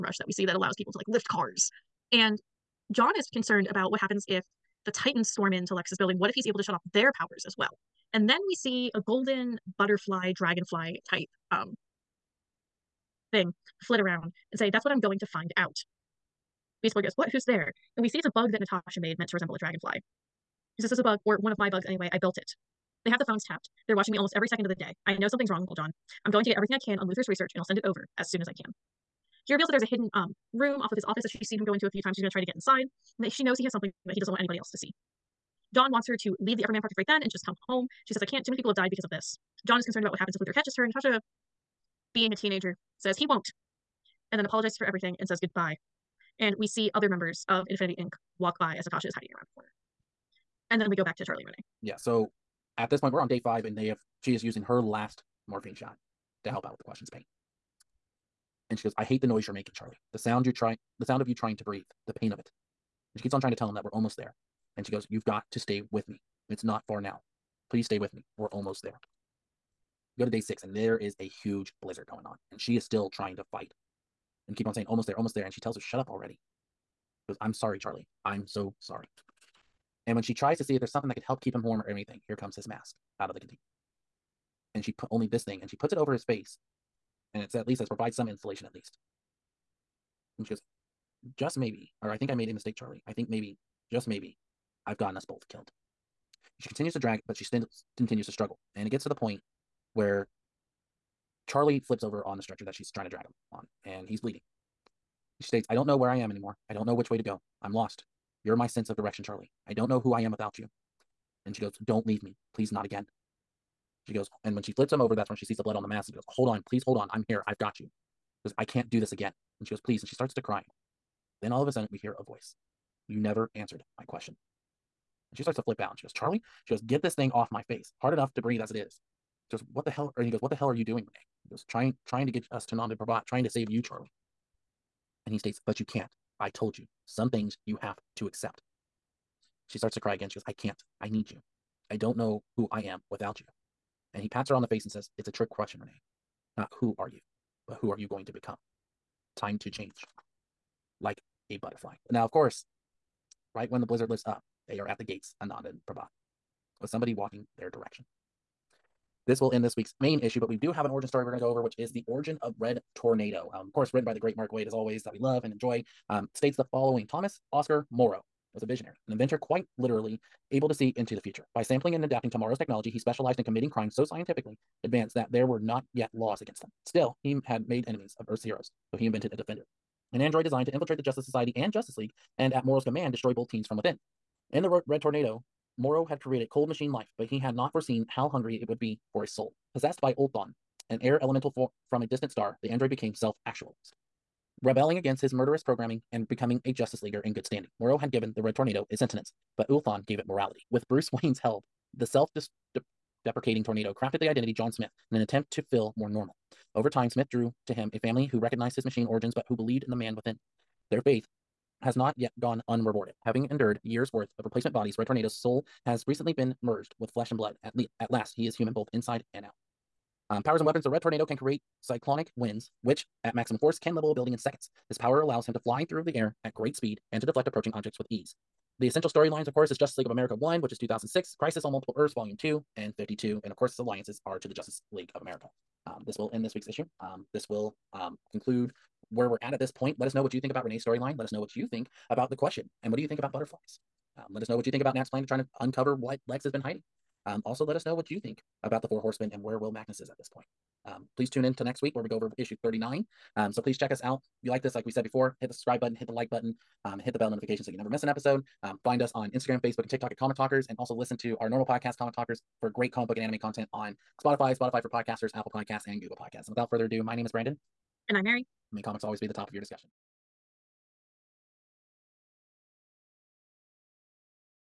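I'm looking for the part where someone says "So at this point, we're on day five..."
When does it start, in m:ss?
0:51.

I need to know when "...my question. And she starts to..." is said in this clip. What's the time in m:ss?
2:03.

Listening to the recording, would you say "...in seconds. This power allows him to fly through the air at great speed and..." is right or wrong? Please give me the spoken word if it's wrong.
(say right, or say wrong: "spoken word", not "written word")
right.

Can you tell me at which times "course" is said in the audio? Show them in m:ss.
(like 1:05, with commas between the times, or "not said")
2:32, 2:43, 3:49, 3:53.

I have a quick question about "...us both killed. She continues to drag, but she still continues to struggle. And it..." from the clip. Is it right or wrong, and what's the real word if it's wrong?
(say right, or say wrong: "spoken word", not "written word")
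right.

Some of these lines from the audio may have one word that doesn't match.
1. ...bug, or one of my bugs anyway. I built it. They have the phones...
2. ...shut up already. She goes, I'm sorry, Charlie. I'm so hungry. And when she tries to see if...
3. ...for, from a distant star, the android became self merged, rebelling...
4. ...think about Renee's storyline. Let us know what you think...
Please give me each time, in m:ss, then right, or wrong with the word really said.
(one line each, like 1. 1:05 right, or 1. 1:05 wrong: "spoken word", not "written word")
1. 0:21 right
2. 1:15 wrong: "sorry", not "hungry"
3. 3:11 wrong: "actualized", not "merged"
4. 4:00 right.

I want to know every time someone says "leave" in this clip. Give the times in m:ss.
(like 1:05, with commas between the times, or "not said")
0:36, 1:52.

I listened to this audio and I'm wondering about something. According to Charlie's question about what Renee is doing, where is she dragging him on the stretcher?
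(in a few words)
Nanda Parbat.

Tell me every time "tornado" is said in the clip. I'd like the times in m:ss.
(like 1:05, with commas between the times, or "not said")
2:42, 3:05, 3:18, 3:23, 3:35, 3:41.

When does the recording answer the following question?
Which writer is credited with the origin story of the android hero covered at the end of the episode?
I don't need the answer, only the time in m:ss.
2:44.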